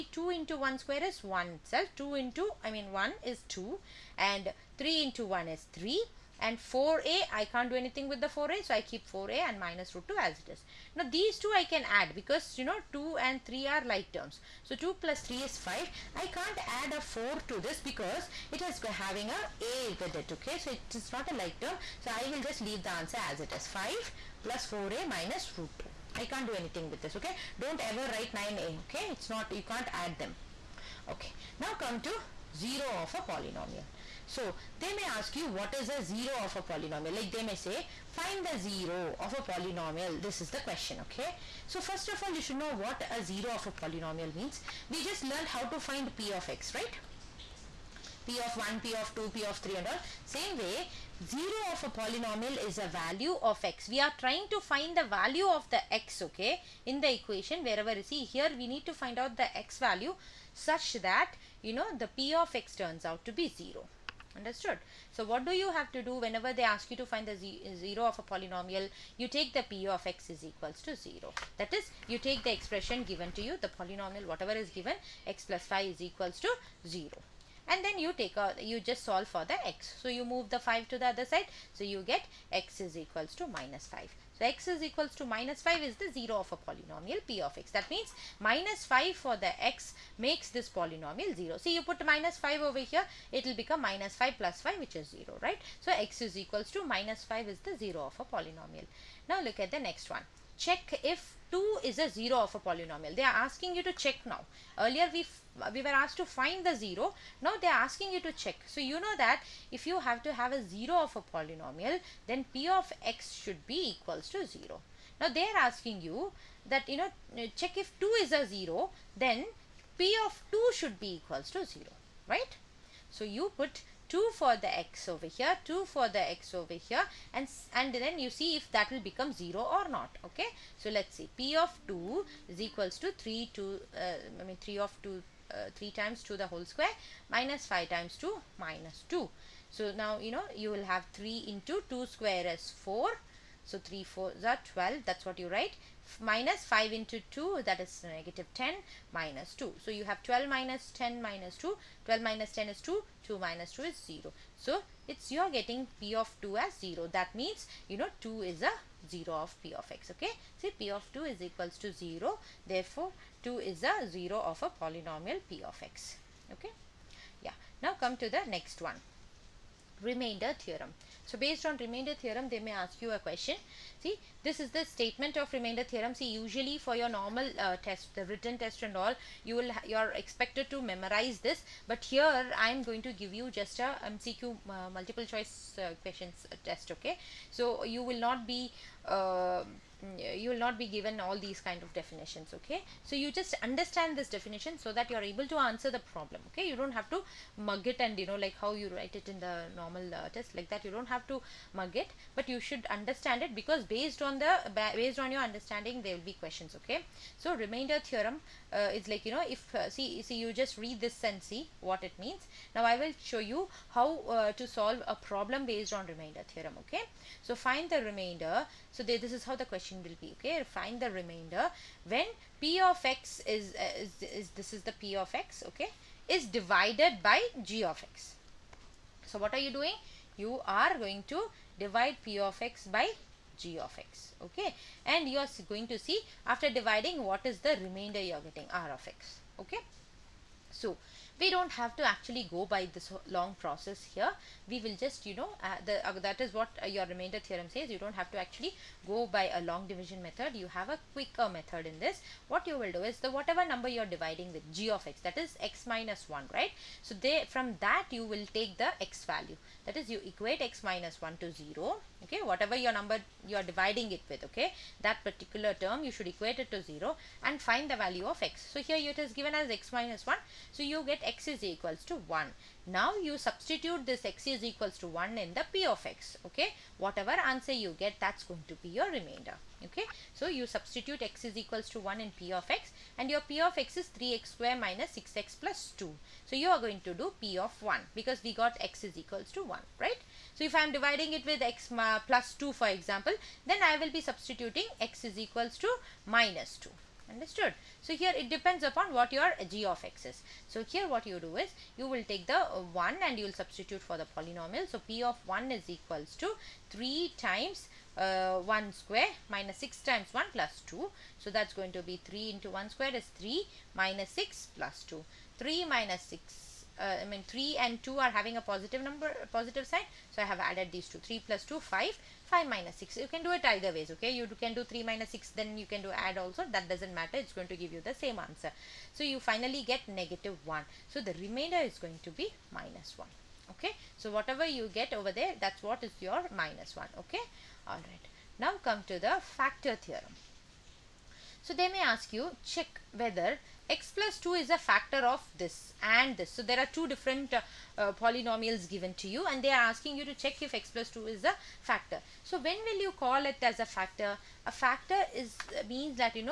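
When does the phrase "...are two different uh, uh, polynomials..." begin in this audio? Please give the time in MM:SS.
05:46.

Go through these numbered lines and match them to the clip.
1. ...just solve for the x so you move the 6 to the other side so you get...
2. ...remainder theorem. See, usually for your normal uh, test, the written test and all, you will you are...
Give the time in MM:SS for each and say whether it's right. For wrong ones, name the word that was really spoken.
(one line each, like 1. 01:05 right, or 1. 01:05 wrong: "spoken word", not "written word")
1. 01:18 wrong: "5", not "6"
2. 02:55 right.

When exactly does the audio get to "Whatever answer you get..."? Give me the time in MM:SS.
04:36.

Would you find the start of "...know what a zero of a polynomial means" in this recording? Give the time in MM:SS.
00:42.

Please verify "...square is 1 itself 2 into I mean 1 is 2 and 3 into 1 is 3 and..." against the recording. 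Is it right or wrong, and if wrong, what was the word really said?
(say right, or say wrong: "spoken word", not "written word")
right.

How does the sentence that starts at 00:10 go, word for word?
Now these two I can add because you know 2 and 3 are like terms.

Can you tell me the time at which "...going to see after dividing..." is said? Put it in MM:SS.
03:55.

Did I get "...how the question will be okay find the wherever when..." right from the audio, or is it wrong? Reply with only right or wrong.
wrong.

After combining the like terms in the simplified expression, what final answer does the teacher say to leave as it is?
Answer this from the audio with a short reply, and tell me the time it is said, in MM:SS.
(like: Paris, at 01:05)
5 + 4a − √2, at 00:23.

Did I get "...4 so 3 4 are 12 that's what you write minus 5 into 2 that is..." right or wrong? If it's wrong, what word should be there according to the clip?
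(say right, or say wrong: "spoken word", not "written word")
right.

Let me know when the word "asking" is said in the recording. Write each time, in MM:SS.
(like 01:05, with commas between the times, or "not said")
01:43, 01:47, 01:55, 05:49.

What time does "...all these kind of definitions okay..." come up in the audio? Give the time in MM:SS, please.
03:11.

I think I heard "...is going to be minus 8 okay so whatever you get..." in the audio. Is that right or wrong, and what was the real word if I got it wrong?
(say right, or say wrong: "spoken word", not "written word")
wrong: "1", not "8".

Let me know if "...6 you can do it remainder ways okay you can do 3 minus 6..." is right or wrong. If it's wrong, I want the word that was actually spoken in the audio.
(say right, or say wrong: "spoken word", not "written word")
wrong: "either", not "remainder".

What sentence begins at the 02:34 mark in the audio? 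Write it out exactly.
So it's you're getting p of 2 as 0.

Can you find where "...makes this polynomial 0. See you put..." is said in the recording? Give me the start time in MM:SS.
01:30.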